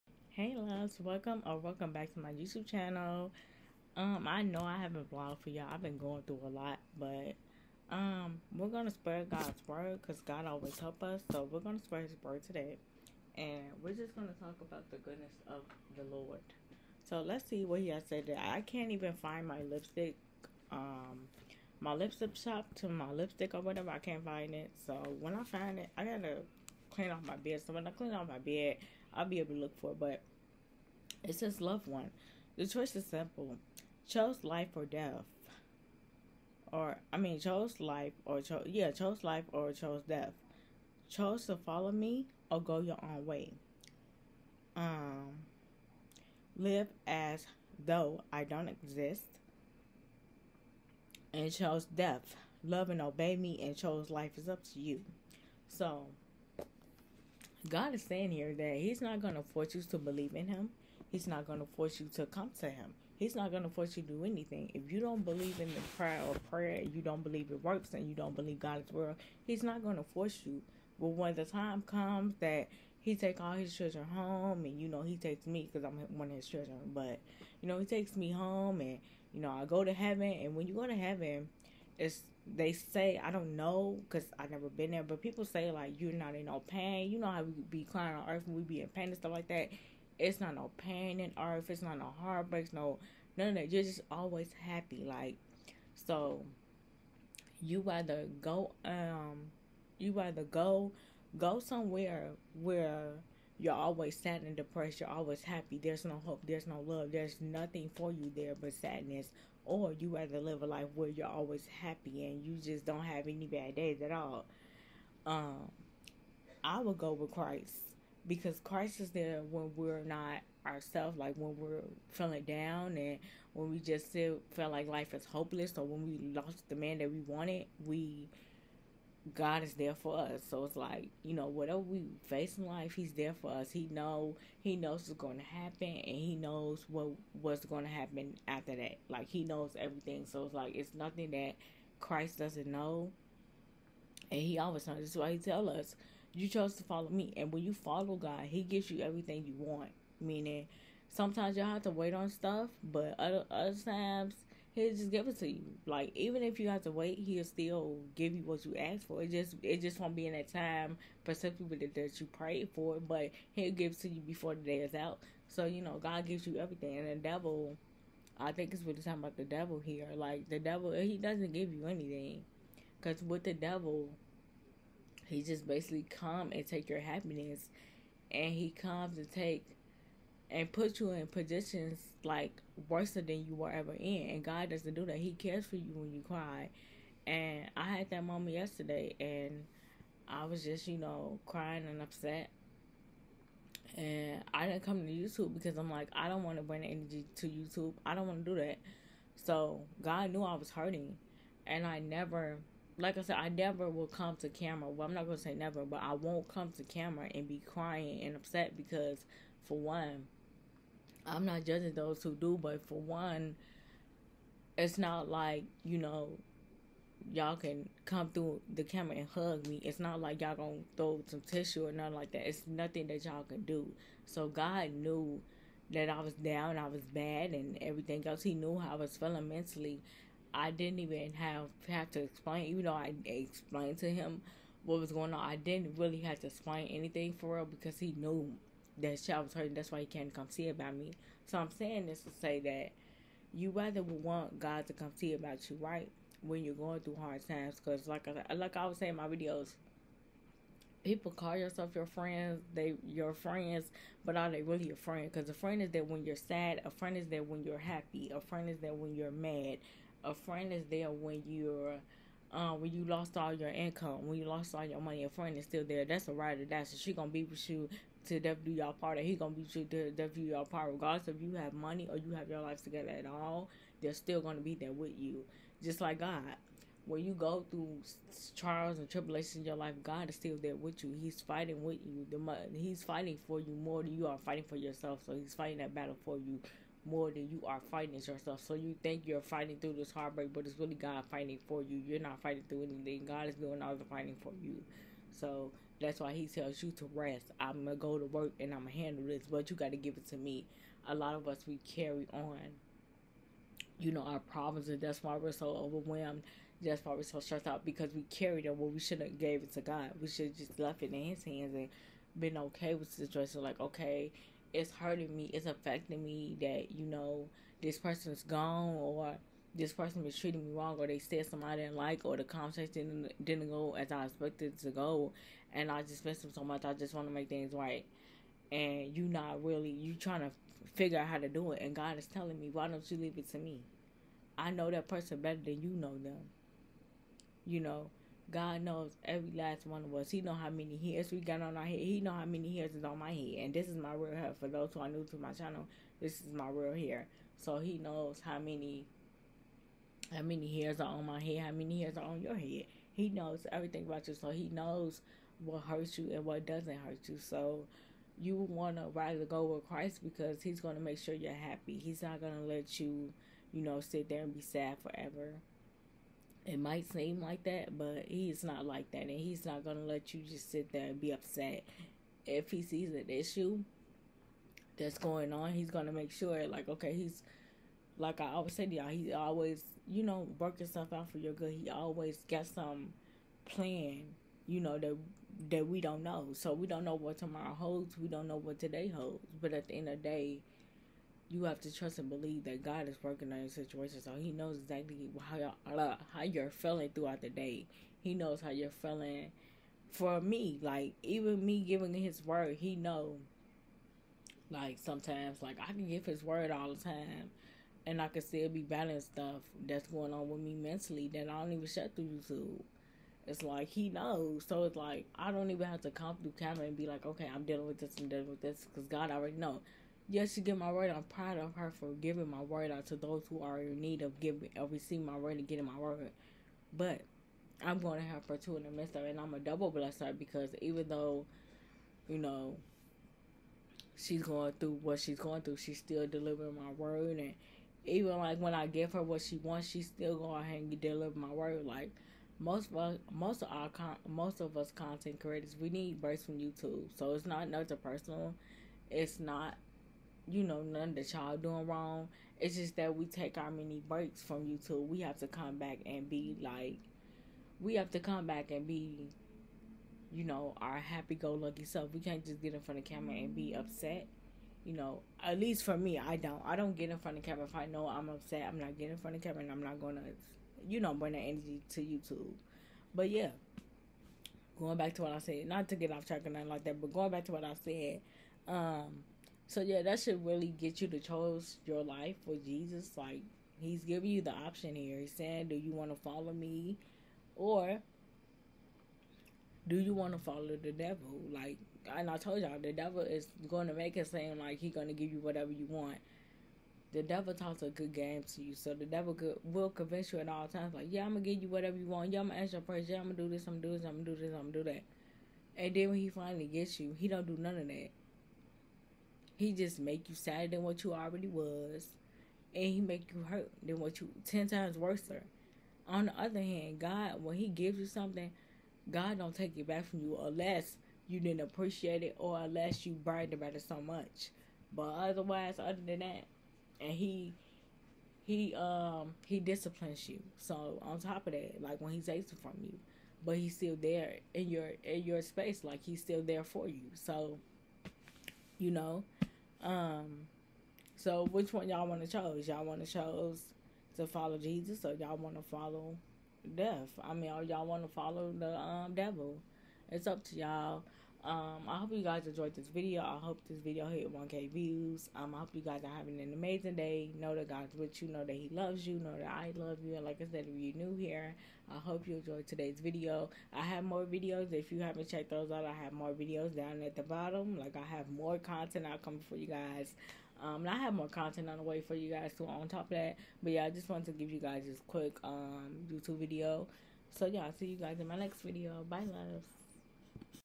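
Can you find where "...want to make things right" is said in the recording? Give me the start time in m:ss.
5:27.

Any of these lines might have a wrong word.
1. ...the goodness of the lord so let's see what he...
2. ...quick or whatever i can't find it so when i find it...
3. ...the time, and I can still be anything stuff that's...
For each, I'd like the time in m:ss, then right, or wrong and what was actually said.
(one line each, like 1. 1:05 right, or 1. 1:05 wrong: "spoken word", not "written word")
1. 0:14 right
2. 0:23 wrong: "lipstick", not "quick"
3. 6:46 wrong: "battling", not "anything".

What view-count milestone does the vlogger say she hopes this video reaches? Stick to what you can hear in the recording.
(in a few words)
1k views.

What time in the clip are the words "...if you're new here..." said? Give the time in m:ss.
9:20.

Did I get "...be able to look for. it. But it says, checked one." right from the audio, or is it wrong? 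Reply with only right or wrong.
wrong.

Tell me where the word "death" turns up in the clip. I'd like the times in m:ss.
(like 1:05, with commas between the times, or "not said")
0:34, 0:40, 0:51, 4:30, 9:06.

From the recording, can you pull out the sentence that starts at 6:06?
It might seem like that, but he's not like that, and he's not gonna let you just sit there and be upset.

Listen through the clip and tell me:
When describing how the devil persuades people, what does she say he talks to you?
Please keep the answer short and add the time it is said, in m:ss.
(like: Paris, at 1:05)
a good game, at 8:17.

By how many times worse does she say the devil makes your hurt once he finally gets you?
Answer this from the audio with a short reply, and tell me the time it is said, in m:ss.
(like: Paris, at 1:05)
10, at 8:34.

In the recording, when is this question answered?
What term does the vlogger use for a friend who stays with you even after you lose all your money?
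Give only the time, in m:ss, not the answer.
4:26.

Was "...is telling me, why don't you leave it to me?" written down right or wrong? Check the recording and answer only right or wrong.
right.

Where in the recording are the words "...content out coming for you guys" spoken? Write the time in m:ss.
9:28.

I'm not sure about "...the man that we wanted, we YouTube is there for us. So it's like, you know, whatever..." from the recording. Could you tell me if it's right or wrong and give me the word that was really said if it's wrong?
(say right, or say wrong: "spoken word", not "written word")
wrong: "God", not "YouTube".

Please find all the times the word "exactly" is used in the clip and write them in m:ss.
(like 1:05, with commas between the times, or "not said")
6:34.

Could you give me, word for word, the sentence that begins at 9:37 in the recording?
So yeah, I'll see you guys in my next video.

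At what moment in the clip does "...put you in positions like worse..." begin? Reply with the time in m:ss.
3:00.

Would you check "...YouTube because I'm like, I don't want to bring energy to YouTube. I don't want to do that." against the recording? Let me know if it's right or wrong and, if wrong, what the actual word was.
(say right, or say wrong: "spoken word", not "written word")
right.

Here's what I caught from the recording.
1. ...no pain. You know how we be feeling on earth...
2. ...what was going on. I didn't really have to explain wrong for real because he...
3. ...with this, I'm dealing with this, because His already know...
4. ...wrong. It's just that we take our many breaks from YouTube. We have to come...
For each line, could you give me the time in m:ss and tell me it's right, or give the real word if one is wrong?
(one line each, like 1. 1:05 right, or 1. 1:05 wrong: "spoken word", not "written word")
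1. 1:26 wrong: "crying", not "feeling"
2. 3:54 wrong: "anything", not "wrong"
3. 6:57 wrong: "God", not "His"
4. 7:31 right.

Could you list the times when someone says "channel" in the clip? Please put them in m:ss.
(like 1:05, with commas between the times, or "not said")
0:02, 5:45.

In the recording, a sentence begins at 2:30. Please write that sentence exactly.
Meaning, sometimes y'all have to wait on stuff, but other, other times, he'll just give it to you.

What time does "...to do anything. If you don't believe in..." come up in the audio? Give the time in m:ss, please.
1:04.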